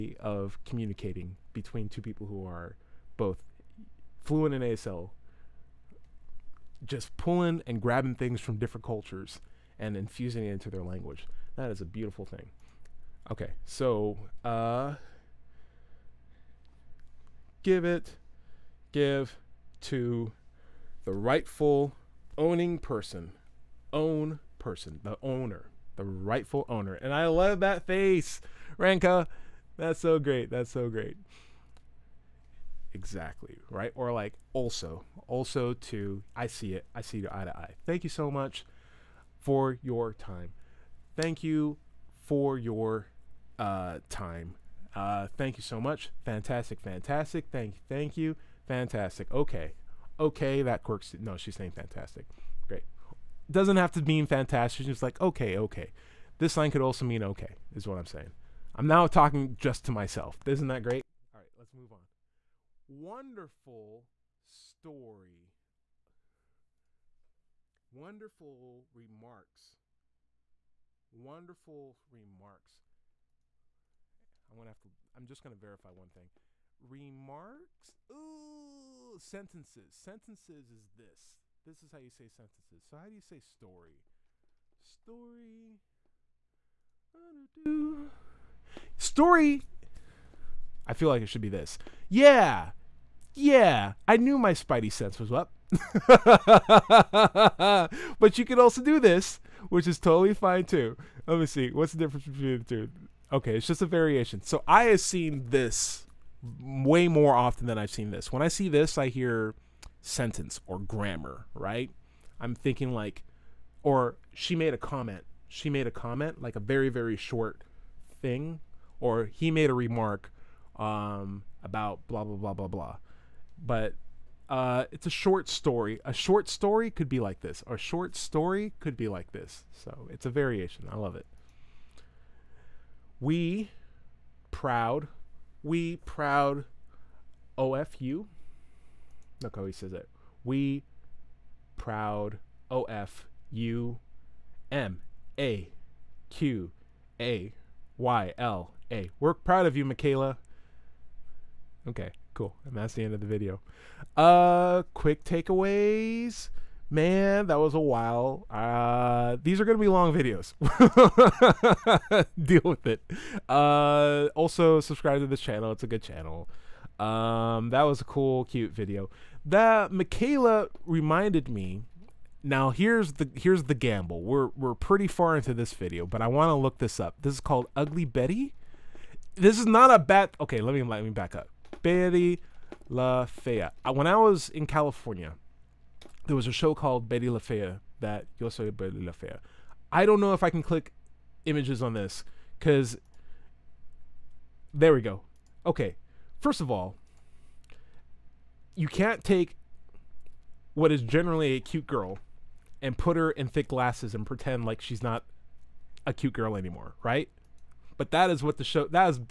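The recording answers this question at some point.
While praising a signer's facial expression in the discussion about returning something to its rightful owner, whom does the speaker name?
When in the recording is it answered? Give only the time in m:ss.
0:28.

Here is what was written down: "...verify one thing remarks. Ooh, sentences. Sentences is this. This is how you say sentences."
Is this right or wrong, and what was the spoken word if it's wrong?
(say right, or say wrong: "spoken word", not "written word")
right.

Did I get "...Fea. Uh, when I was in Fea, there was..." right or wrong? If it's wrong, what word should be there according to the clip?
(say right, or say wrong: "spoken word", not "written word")
wrong: "California", not "Fea".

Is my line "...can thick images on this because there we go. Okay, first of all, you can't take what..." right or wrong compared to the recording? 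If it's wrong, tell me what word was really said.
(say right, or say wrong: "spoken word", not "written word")
wrong: "click", not "thick".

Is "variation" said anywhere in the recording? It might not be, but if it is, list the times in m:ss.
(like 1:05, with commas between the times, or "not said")
1:43, 2:10.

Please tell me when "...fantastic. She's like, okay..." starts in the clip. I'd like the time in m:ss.
0:54.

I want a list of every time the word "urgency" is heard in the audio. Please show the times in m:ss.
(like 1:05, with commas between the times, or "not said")
not said.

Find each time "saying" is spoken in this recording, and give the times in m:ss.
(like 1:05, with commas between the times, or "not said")
0:51, 0:58.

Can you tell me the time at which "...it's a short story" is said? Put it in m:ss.
2:04.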